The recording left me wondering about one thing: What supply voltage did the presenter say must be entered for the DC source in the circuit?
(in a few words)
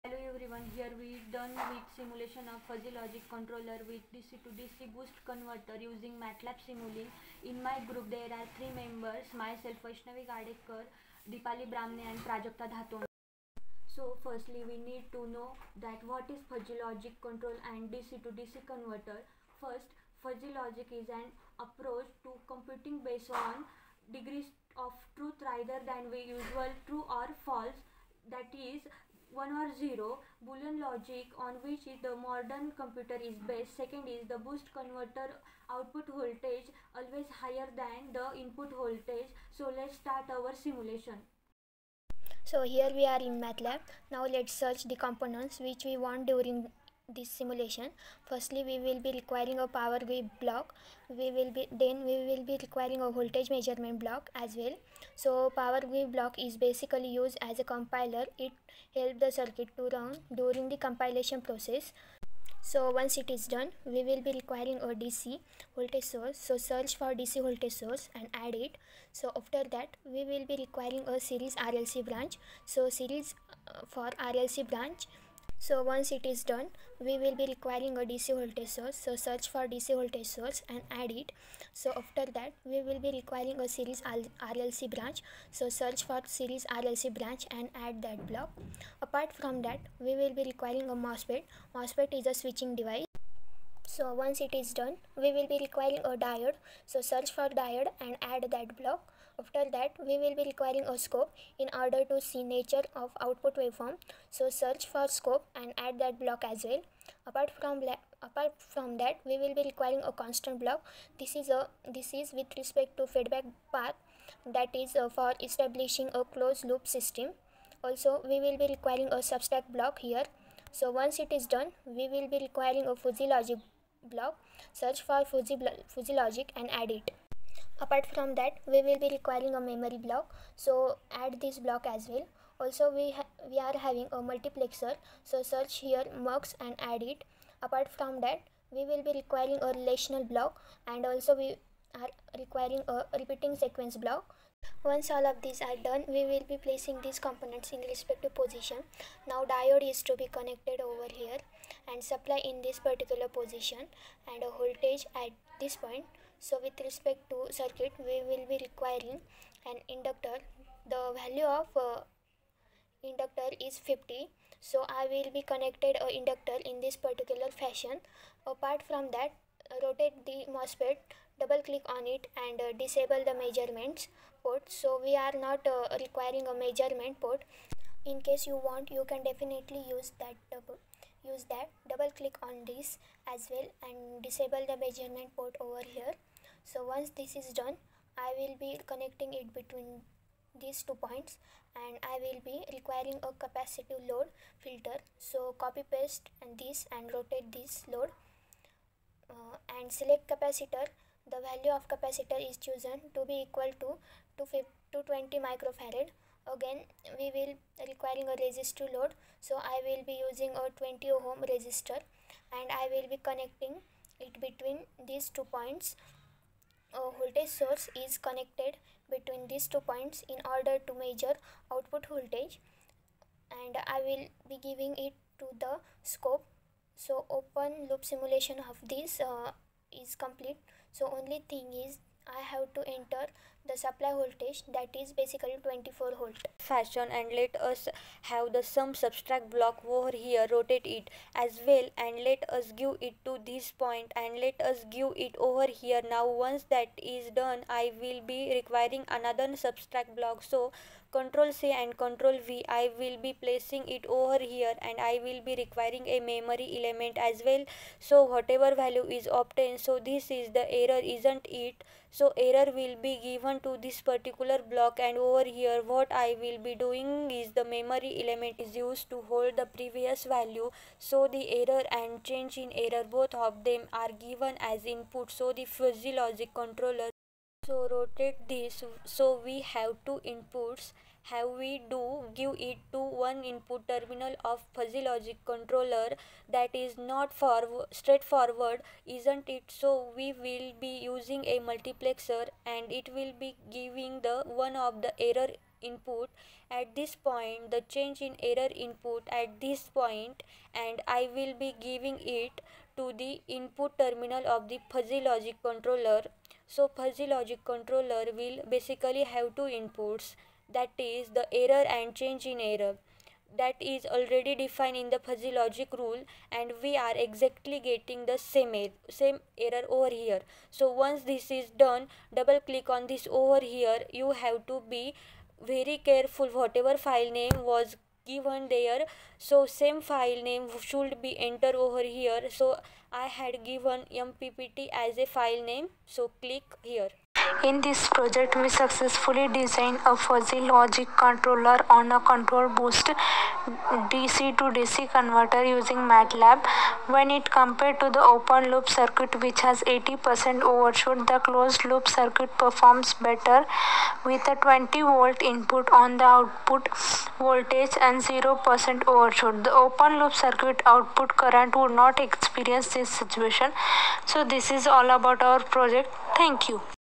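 24 volt.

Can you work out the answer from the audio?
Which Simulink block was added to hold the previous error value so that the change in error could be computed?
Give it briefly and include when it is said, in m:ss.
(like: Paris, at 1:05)
memory block, at 2:09.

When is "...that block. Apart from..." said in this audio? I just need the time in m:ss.
1:28.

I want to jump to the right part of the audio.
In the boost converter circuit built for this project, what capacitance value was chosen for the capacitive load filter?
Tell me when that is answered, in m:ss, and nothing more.
3:24.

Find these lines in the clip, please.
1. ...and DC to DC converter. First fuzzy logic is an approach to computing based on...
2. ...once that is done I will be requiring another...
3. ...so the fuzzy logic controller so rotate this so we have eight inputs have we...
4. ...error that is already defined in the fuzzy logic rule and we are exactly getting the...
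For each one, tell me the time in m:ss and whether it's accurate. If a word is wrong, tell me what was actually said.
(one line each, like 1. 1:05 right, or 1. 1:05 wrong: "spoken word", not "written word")
1. 0:17 right
2. 4:06 right
3. 4:35 wrong: "two", not "eight"
4. 5:12 right.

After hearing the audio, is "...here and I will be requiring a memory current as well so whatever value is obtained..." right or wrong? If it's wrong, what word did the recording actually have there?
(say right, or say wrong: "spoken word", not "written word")
wrong: "element", not "current".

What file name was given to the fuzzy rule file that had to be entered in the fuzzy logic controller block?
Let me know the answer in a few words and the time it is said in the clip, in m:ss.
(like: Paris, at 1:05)
mppt, at 5:34.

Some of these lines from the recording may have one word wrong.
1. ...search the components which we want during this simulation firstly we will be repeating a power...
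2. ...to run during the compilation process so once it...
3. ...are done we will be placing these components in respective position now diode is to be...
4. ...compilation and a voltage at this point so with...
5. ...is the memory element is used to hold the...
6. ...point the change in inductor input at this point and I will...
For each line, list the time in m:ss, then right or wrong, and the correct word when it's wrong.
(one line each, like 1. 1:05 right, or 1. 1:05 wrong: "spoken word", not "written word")
1. 0:44 wrong: "requiring", not "repeating"
2. 0:59 right
3. 2:25 right
4. 2:33 wrong: "position", not "compilation"
5. 4:27 right
6. 4:57 wrong: "error", not "inductor".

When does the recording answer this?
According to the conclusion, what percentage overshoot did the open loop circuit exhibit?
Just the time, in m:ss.
5:49.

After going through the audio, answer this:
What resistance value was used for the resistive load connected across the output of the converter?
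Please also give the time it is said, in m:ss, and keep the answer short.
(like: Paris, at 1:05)
20 ohm, at 3:30.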